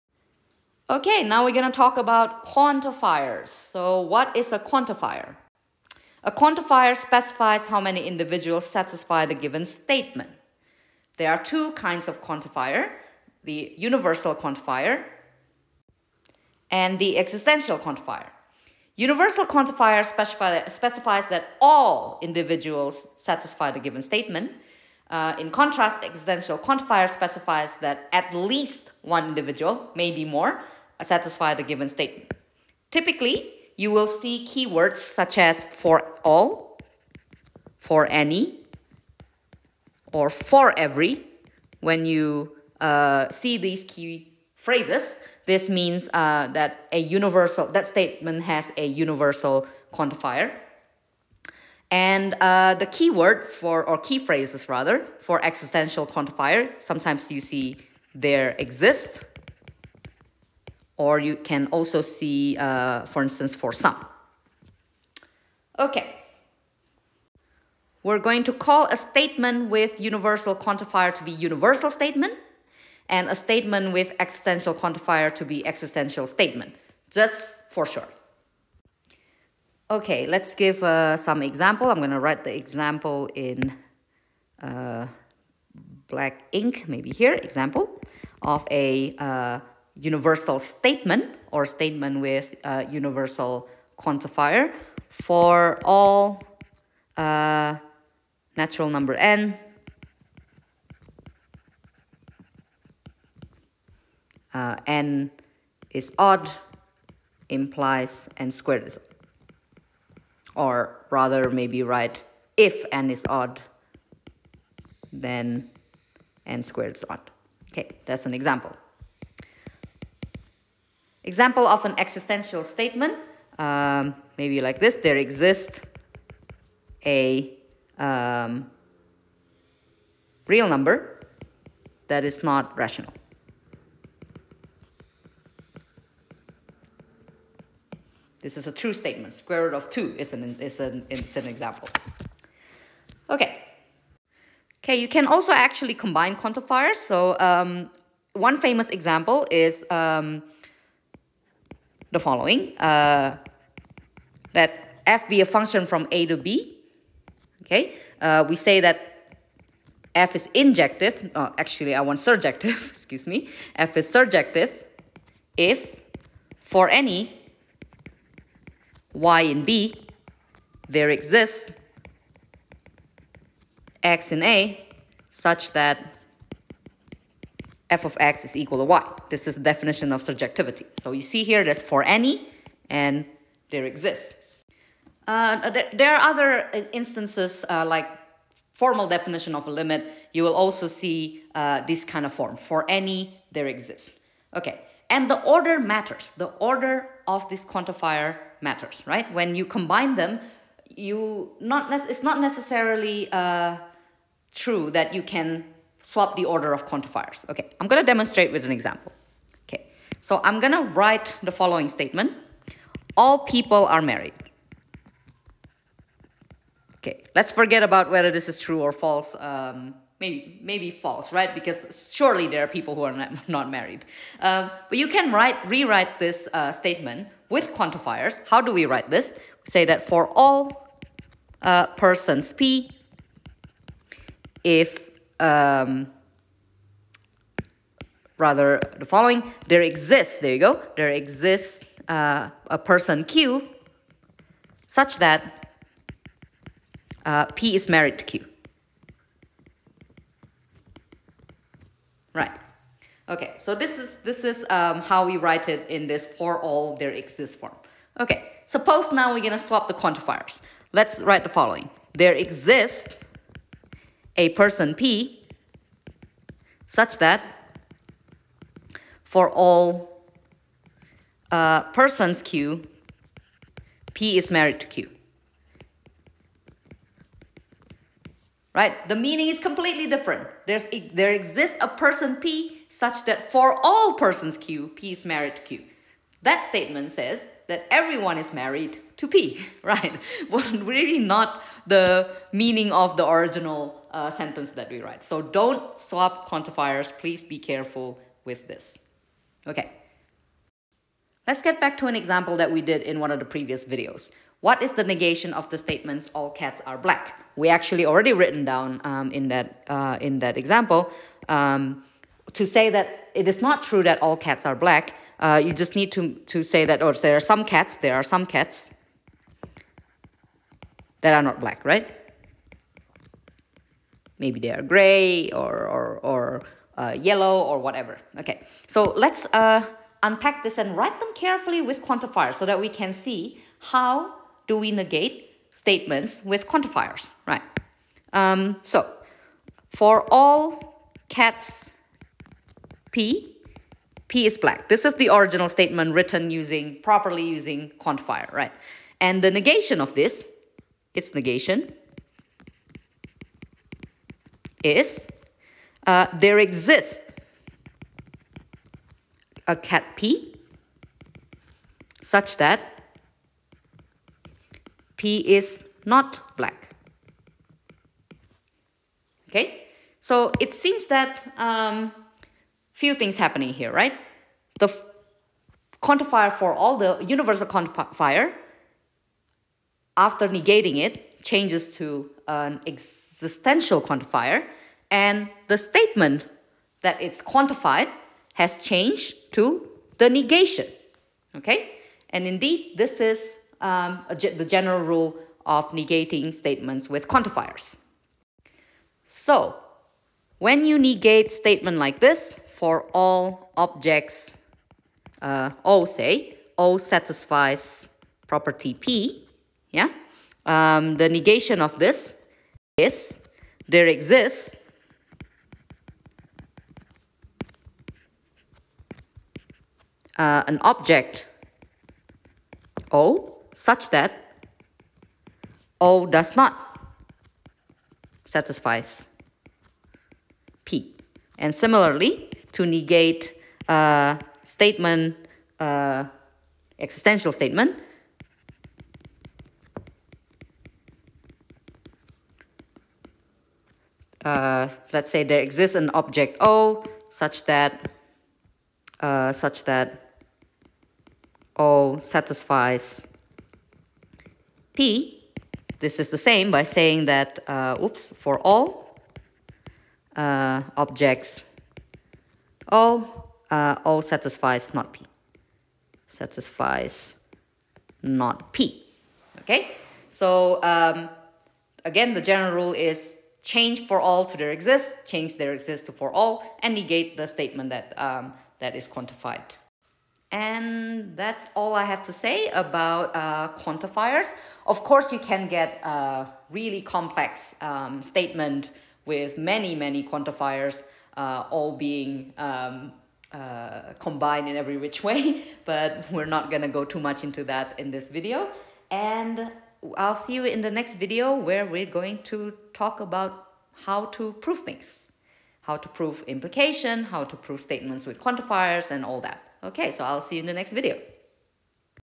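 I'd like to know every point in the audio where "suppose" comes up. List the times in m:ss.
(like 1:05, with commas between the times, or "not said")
4:18.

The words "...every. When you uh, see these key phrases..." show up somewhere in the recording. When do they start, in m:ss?
0:40.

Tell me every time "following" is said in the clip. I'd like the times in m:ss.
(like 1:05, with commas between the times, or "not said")
2:32, 3:31, 3:59, 4:21.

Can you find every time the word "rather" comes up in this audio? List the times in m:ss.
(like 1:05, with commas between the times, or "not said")
0:54, 1:51, 3:58.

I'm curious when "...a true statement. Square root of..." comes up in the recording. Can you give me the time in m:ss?
2:18.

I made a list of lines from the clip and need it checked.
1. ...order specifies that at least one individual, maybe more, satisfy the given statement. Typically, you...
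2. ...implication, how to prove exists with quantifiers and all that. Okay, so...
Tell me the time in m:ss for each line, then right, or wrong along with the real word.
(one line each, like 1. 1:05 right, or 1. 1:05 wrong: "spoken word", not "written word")
1. 0:26 wrong: "quantifier", not "order"
2. 8:26 wrong: "statements", not "exists".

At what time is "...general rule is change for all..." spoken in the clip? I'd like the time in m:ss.
7:52.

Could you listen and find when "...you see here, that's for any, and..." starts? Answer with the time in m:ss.
3:01.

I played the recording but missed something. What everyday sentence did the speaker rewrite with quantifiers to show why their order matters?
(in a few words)
All people are married.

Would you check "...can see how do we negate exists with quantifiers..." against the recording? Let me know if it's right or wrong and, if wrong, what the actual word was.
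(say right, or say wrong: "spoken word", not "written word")
wrong: "statements", not "exists".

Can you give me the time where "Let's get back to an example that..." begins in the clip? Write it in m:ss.
5:01.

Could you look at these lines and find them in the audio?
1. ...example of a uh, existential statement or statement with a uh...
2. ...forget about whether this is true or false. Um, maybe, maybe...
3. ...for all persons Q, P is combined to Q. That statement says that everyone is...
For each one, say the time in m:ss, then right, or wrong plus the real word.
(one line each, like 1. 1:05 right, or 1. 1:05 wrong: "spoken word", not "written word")
1. 1:27 wrong: "universal", not "existential"
2. 3:37 right
3. 4:43 wrong: "married", not "combined".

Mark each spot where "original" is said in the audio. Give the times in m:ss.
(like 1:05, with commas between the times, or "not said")
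4:53, 5:45.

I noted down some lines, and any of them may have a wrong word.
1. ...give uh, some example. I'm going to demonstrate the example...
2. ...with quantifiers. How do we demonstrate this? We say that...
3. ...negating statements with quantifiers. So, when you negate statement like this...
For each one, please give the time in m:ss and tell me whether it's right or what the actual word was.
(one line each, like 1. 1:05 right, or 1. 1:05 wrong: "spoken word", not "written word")
1. 1:20 wrong: "write", not "demonstrate"
2. 3:47 wrong: "write", not "demonstrate"
3. 6:35 right.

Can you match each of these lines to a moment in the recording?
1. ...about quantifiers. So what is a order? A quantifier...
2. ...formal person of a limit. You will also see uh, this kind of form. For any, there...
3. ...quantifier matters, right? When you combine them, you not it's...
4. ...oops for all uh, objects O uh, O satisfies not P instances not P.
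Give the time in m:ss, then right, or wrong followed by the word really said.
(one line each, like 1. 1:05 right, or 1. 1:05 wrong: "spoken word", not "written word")
1. 0:01 wrong: "quantifier", not "order"
2. 3:08 wrong: "definition", not "person"
3. 3:17 right
4. 7:38 wrong: "satisfies", not "instances".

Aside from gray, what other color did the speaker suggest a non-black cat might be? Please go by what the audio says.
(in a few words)
yellow.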